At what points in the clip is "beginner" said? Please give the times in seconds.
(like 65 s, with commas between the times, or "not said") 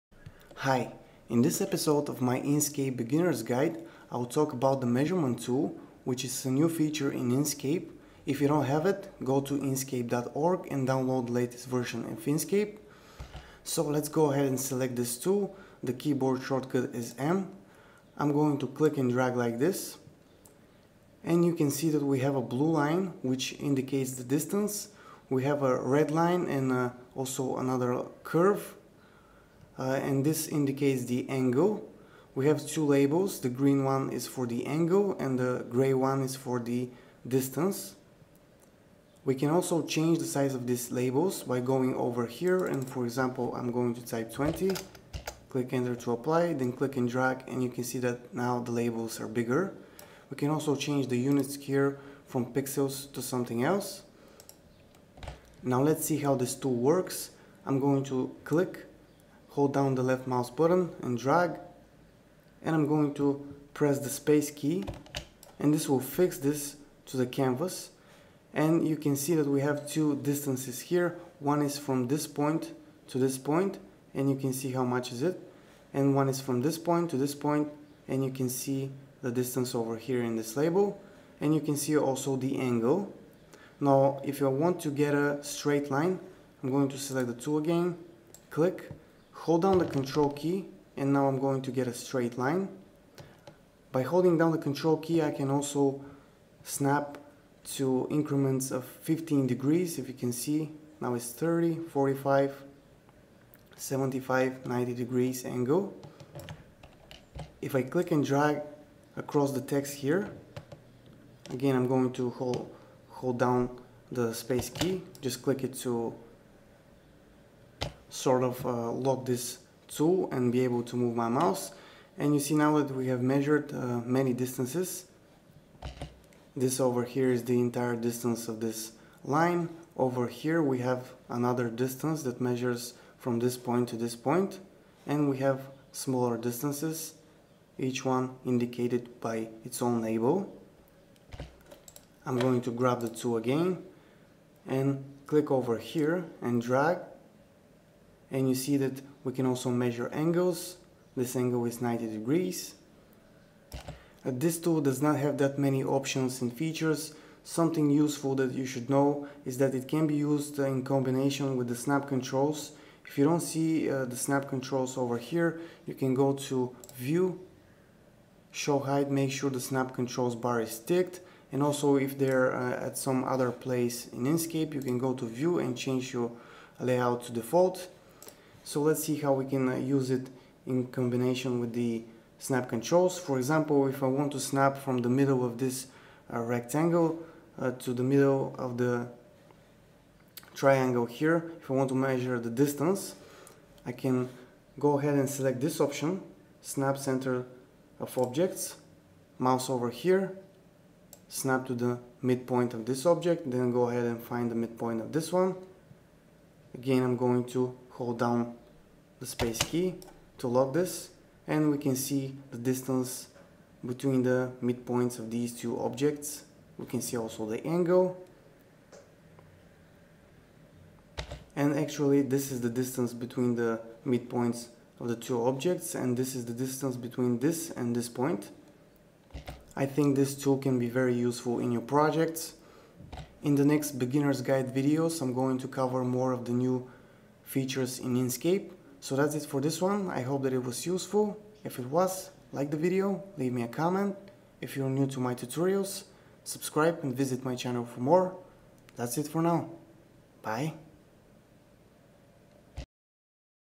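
2 s, 233 s.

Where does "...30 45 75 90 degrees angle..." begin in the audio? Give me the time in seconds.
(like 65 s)
101 s.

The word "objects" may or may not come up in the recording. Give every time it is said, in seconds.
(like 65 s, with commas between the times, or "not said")
198 s, 203 s, 215 s, 225 s.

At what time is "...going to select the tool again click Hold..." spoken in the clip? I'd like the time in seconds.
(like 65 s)
86 s.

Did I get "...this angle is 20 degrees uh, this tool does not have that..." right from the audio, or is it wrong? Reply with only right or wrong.
wrong.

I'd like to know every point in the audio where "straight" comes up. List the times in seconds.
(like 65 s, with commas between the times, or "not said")
85 s, 91 s.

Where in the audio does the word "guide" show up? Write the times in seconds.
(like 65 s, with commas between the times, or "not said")
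3 s, 234 s.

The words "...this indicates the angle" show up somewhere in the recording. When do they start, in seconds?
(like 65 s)
30 s.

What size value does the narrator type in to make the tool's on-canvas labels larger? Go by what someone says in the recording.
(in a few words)
20.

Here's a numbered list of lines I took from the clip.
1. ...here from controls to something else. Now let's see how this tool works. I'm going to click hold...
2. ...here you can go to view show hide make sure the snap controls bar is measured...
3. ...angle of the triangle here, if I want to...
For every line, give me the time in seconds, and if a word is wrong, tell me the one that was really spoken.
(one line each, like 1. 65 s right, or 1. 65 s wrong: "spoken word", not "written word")
1. 51 s wrong: "pixels", not "controls"
2. 165 s wrong: "ticked", not "measured"
3. 188 s wrong: "middle", not "angle".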